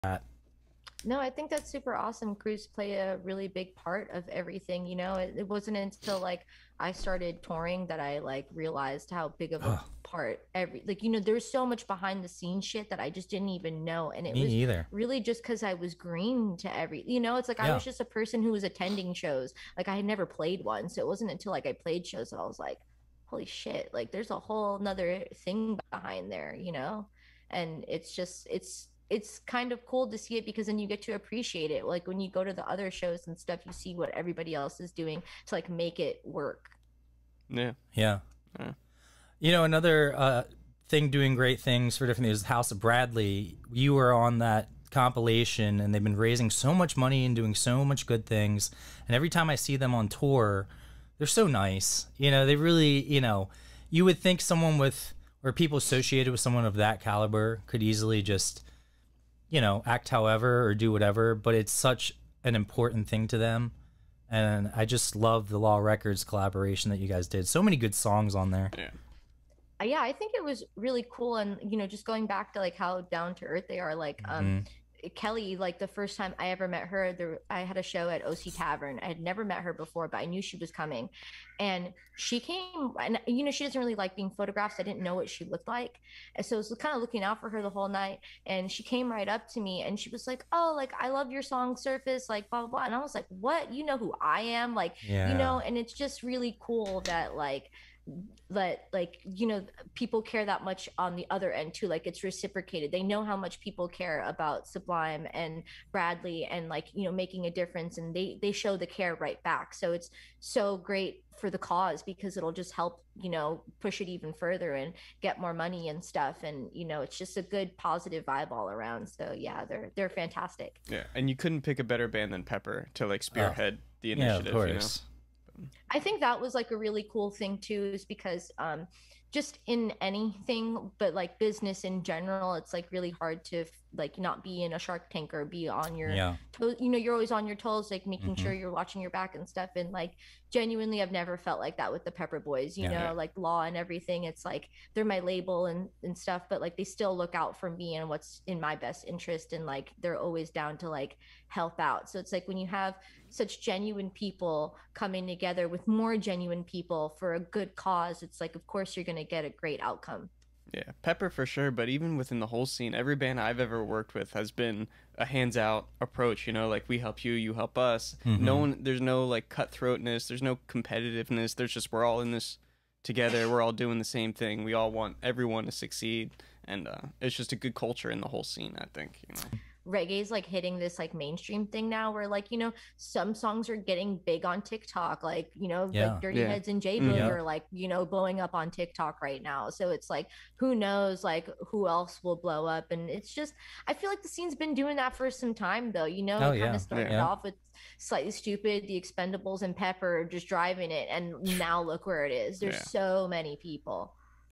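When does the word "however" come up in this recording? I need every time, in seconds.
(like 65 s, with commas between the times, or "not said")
60 s.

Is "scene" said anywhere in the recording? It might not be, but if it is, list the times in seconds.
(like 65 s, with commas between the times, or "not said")
12 s, 162 s, 178 s, 194 s.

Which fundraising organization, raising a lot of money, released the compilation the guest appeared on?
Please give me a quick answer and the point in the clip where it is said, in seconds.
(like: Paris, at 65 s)
House of Bradley, at 42 s.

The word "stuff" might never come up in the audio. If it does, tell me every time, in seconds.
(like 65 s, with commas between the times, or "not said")
33 s, 116 s, 139 s, 146 s.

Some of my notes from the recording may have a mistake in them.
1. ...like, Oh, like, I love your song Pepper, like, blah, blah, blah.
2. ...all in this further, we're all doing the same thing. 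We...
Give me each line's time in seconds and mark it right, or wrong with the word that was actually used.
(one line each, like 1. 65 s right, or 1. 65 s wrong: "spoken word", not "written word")
1. 90 s wrong: "Surface", not "Pepper"
2. 172 s wrong: "together", not "further".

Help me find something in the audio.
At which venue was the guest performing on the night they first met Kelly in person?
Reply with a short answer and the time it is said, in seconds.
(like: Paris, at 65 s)
OC Tavern, at 78 s.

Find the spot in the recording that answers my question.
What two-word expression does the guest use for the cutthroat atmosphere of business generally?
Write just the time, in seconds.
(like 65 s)
134 s.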